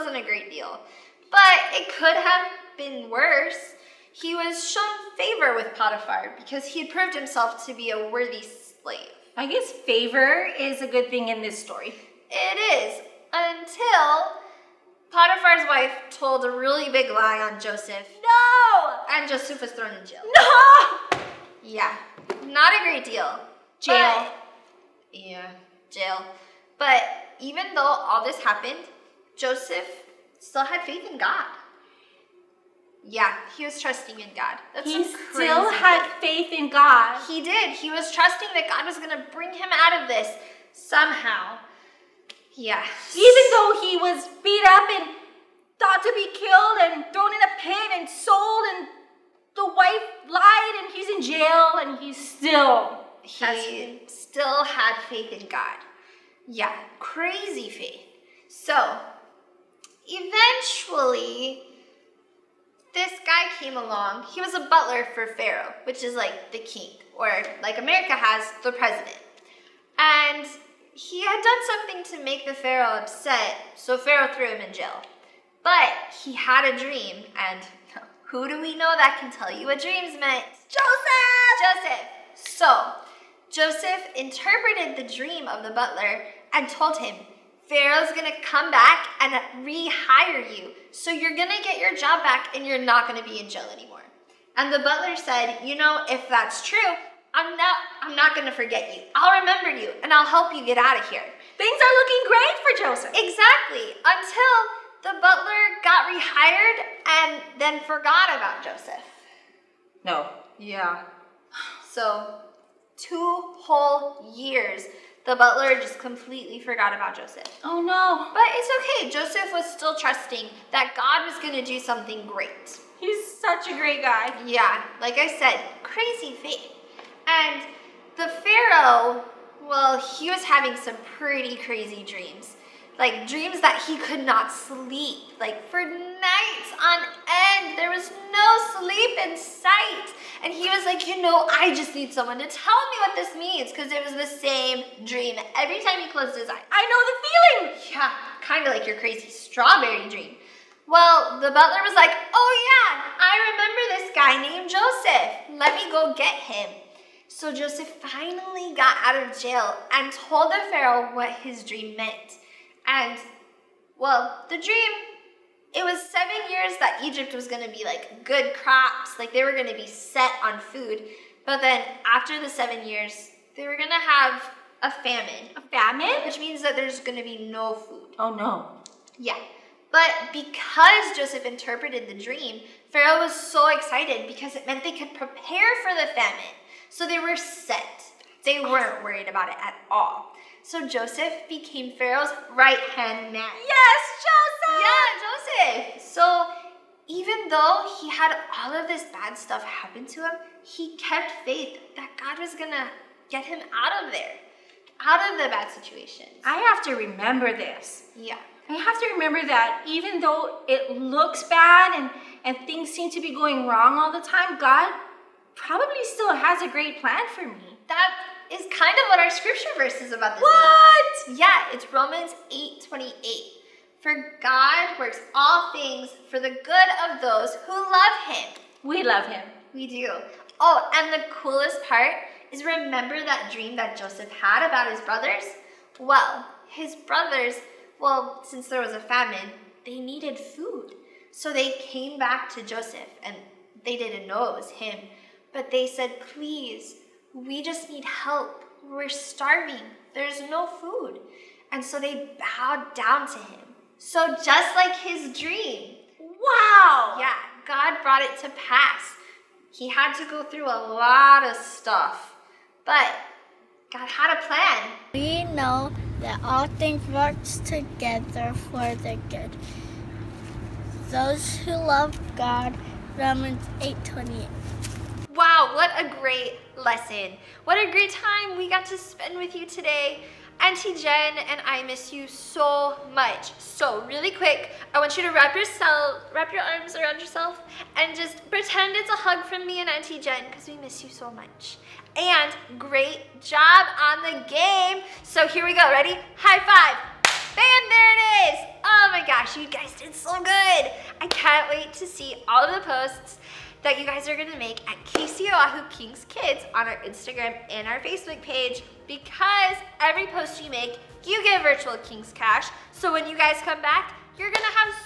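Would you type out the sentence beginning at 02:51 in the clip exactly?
But then after the seven years, they were going to have a famine.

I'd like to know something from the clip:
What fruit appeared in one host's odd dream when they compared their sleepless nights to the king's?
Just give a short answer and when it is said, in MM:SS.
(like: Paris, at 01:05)
Strawberry, at 02:29.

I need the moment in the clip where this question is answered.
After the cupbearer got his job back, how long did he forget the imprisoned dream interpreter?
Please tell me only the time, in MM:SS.
01:52.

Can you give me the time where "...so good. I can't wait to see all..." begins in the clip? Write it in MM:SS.
05:00.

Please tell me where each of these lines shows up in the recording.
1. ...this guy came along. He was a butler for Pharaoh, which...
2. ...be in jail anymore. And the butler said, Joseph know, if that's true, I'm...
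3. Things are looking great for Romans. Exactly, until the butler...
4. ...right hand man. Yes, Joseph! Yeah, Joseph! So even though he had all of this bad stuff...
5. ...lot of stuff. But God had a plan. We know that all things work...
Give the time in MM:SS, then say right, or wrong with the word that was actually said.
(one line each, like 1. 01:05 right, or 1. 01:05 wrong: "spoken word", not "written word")
1. 01:02 right
2. 01:33 wrong: "You", not "Joseph"
3. 01:41 wrong: "Joseph", not "Romans"
4. 03:12 right
5. 04:20 right.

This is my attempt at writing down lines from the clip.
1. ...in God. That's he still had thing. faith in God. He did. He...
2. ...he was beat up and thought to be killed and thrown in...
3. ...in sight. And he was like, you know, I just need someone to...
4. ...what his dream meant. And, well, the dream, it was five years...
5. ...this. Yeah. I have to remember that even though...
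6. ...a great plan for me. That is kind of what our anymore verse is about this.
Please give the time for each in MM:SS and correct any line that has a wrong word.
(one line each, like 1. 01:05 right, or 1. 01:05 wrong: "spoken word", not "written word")
1. 00:34 right
2. 00:43 right
3. 02:19 right
4. 02:41 wrong: "seven", not "five"
5. 03:27 right
6. 03:36 wrong: "scripture", not "anymore".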